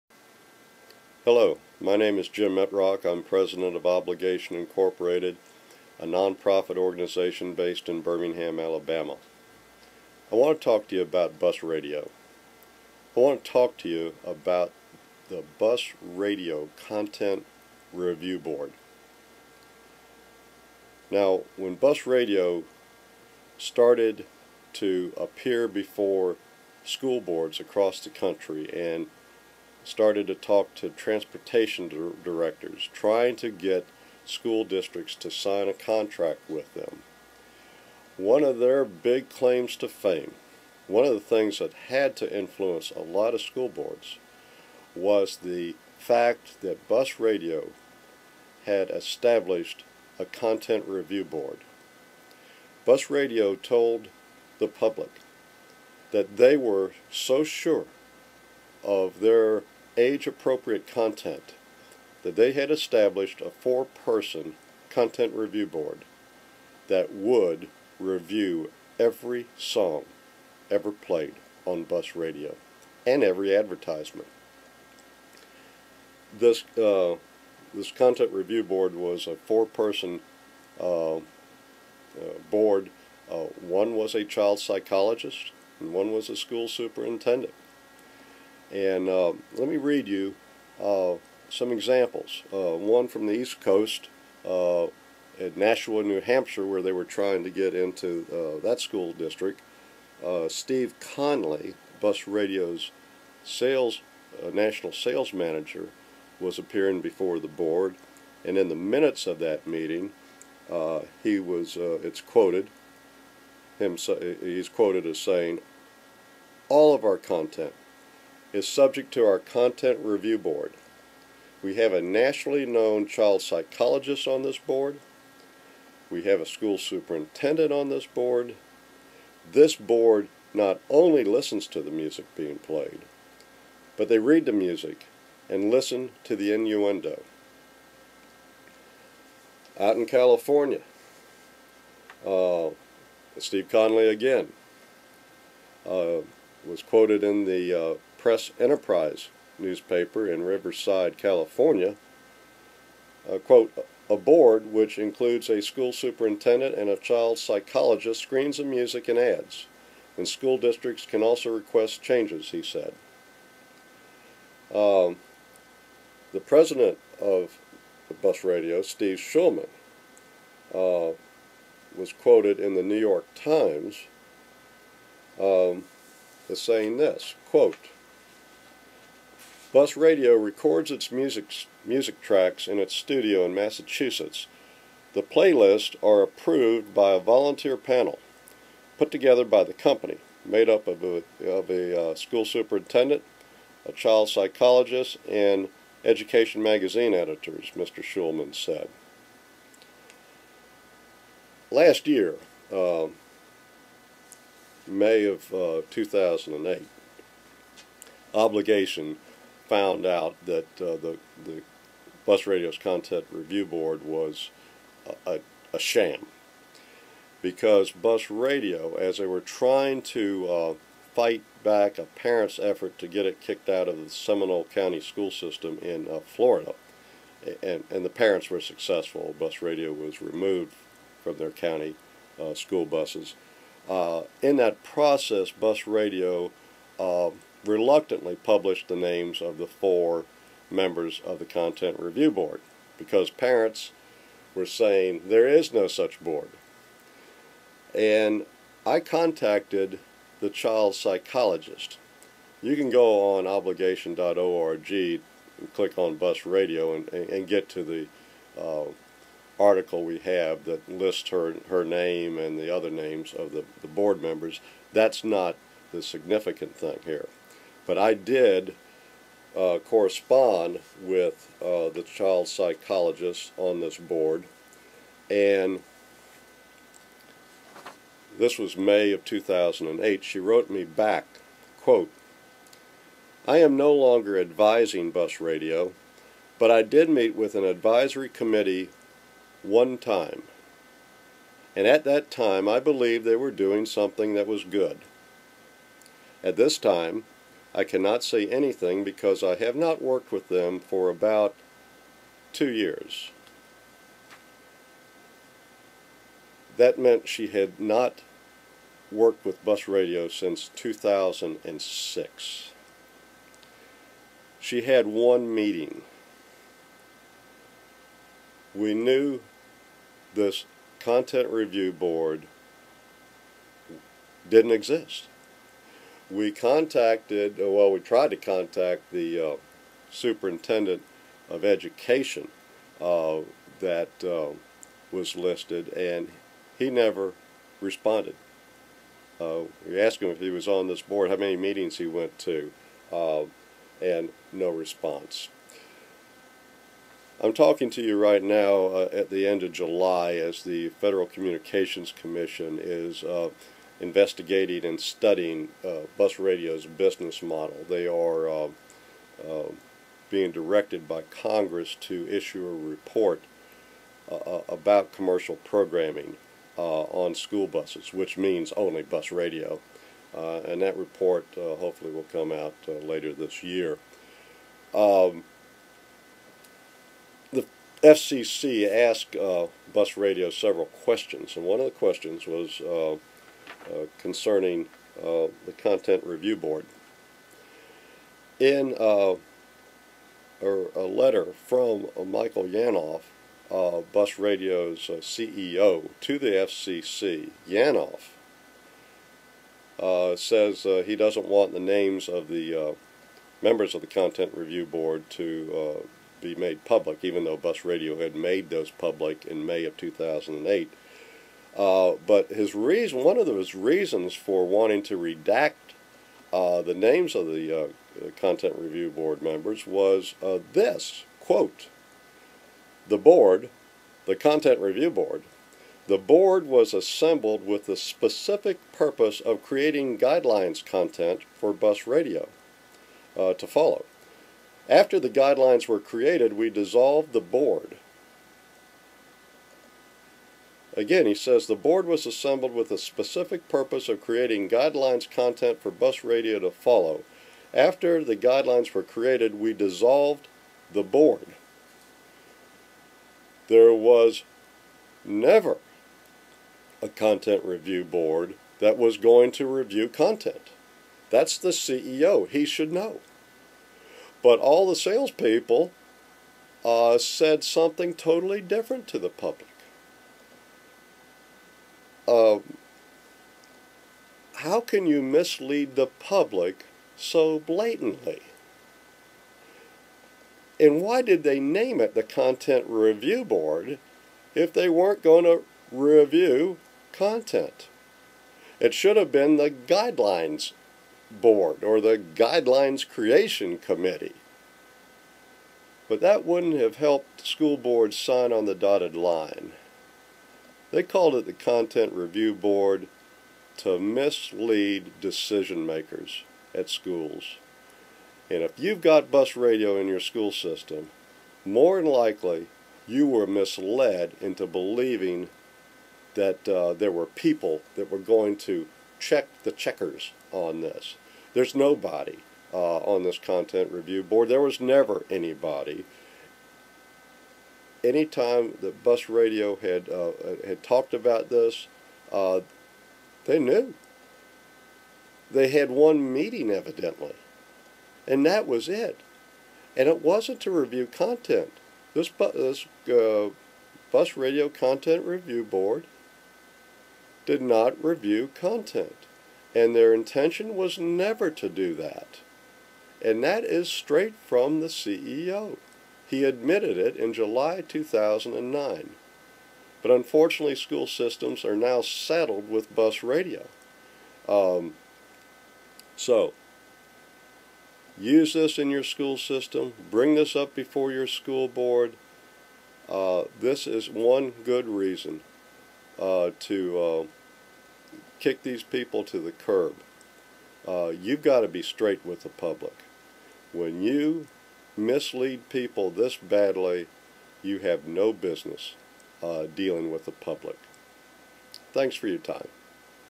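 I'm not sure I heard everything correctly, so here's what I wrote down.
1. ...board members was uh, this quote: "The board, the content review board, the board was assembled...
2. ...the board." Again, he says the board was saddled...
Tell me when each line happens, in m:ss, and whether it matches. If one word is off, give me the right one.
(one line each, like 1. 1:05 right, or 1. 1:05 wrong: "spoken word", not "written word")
1. 6:59 right
2. 7:17 wrong: "assembled", not "saddled".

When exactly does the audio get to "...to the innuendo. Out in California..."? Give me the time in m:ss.
2:16.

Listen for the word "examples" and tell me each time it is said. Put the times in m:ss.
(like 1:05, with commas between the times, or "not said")
1:31.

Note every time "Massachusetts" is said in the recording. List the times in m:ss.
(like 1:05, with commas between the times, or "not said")
3:03.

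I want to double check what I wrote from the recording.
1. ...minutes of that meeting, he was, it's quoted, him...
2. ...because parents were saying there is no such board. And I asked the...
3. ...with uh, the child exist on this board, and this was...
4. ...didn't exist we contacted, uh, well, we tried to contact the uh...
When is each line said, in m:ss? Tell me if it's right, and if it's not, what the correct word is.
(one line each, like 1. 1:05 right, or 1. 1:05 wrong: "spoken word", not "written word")
1. 1:48 right
2. 4:02 wrong: "contacted", not "asked"
3. 4:31 wrong: "psychologist", not "exist"
4. 5:24 right.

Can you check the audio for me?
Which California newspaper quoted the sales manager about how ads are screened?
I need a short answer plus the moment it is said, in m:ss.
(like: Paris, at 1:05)
Press Enterprise, at 2:28.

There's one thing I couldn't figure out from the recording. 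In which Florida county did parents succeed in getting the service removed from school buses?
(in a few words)
Seminole County.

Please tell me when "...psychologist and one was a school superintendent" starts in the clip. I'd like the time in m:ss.
1:24.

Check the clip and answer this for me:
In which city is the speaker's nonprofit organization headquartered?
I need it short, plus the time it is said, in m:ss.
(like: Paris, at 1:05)
Birmingham, Alabama, at 0:08.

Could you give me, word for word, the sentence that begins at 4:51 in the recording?
And at that time, I believed they were doing something that was good.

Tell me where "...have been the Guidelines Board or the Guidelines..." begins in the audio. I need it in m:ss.
8:09.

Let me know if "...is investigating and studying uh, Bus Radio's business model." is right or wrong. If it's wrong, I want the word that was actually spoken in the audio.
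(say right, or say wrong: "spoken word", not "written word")
right.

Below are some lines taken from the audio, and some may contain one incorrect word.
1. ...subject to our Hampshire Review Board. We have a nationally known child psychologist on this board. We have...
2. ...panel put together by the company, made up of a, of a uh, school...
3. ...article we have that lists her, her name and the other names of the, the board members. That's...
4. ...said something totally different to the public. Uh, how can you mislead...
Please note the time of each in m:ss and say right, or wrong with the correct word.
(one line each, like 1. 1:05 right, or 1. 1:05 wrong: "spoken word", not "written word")
1. 1:58 wrong: "Content", not "Hampshire"
2. 3:07 right
3. 4:19 right
4. 7:47 right.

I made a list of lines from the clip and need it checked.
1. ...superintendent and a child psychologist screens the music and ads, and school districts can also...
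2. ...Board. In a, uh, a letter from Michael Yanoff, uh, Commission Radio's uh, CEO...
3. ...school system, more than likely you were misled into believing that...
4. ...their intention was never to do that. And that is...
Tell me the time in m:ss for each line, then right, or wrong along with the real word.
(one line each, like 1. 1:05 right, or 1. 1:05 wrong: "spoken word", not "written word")
1. 2:35 right
2. 6:26 wrong: "Bus", not "Commission"
3. 8:30 right
4. 9:09 right.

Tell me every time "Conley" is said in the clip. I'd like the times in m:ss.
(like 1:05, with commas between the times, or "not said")
1:40, 2:23.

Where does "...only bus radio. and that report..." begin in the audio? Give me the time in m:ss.
6:08.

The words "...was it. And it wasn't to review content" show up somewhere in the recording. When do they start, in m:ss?
8:58.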